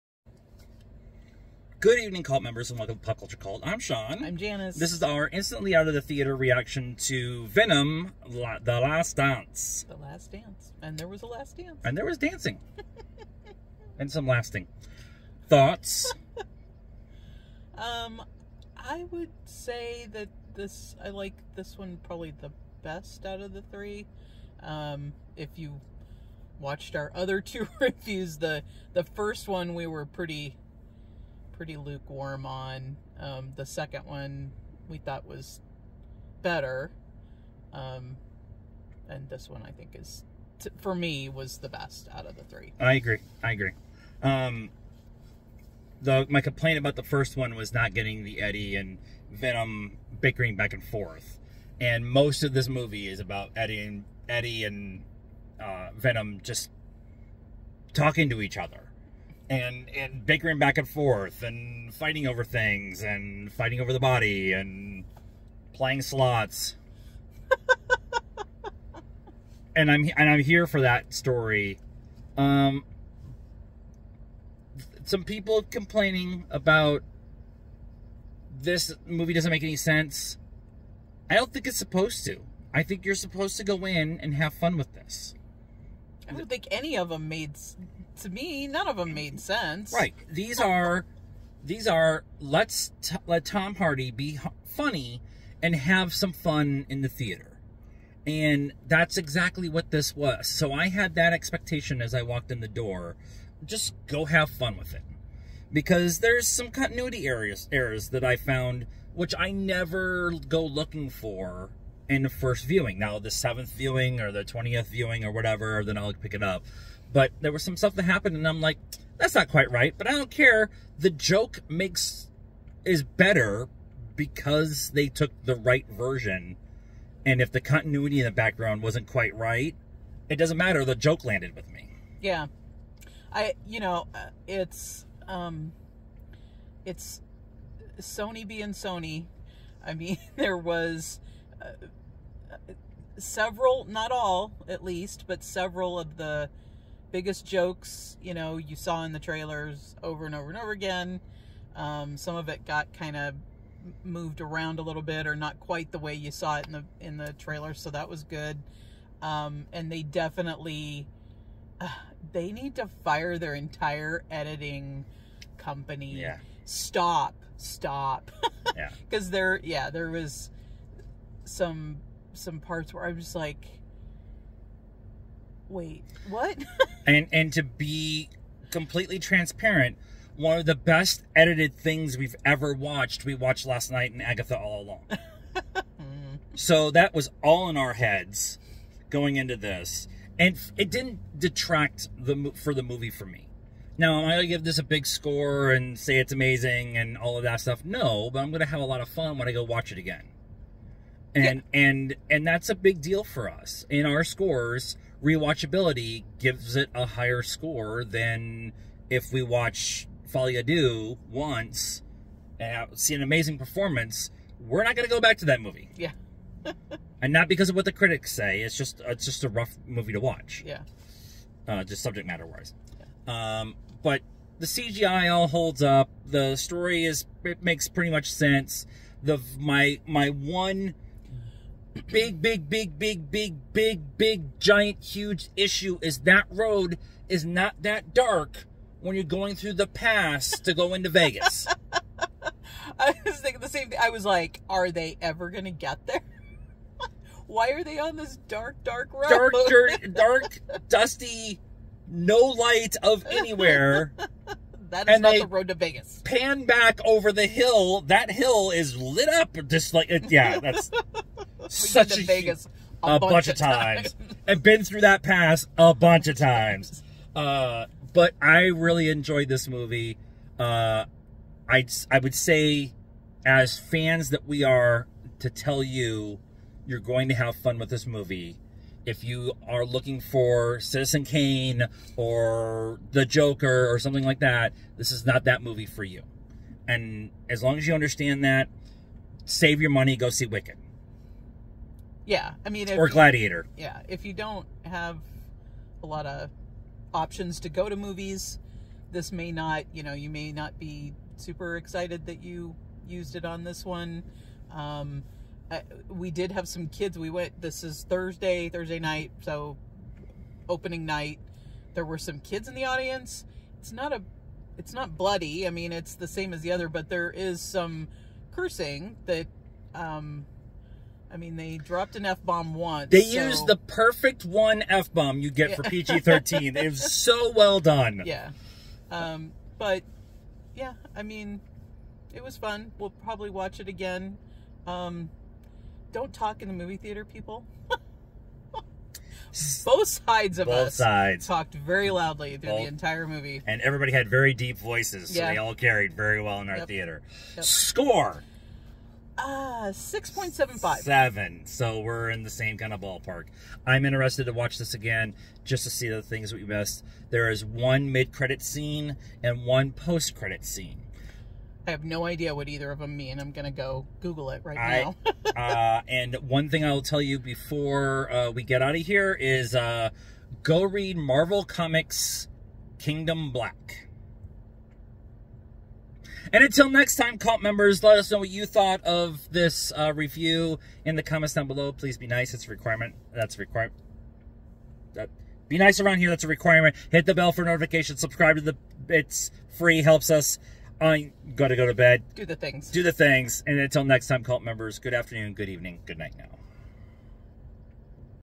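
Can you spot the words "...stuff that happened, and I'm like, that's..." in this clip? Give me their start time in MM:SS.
01:57.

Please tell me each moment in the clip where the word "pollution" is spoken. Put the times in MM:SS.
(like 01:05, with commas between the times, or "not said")
not said.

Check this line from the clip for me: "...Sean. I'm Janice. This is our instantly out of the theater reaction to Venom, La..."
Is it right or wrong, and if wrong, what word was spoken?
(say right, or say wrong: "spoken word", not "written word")
right.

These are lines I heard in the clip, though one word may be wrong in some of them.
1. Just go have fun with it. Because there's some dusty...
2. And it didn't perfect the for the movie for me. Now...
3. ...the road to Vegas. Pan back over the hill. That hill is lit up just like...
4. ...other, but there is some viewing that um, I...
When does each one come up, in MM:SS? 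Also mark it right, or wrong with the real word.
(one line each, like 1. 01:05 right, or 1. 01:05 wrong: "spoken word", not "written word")
1. 01:43 wrong: "continuity", not "dusty"
2. 03:10 wrong: "detract", not "perfect"
3. 04:15 right
4. 05:16 wrong: "cursing", not "viewing".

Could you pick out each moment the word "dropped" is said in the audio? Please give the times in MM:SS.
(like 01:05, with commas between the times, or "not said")
05:21.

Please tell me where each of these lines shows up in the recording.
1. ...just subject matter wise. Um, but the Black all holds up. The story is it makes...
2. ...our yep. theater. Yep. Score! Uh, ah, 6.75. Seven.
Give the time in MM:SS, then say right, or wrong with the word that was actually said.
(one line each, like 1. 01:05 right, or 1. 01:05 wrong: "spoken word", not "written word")
1. 03:41 wrong: "CGI", not "Black"
2. 05:46 right.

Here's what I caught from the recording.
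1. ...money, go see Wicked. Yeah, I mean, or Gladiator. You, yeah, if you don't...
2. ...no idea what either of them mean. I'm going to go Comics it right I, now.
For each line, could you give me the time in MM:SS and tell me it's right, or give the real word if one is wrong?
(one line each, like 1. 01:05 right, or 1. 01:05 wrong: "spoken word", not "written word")
1. 04:49 right
2. 06:02 wrong: "Google", not "Comics".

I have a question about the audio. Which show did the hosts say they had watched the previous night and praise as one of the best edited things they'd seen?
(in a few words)
Agatha All Along.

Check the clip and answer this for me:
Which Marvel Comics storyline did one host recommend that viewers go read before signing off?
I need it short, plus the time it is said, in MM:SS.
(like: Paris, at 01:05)
King in Black, at 06:12.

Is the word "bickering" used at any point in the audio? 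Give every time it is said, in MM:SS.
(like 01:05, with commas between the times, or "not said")
00:50, 01:00.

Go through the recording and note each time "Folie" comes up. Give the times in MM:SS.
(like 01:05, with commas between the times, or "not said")
03:30.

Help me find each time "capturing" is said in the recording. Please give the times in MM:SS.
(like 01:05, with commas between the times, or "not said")
not said.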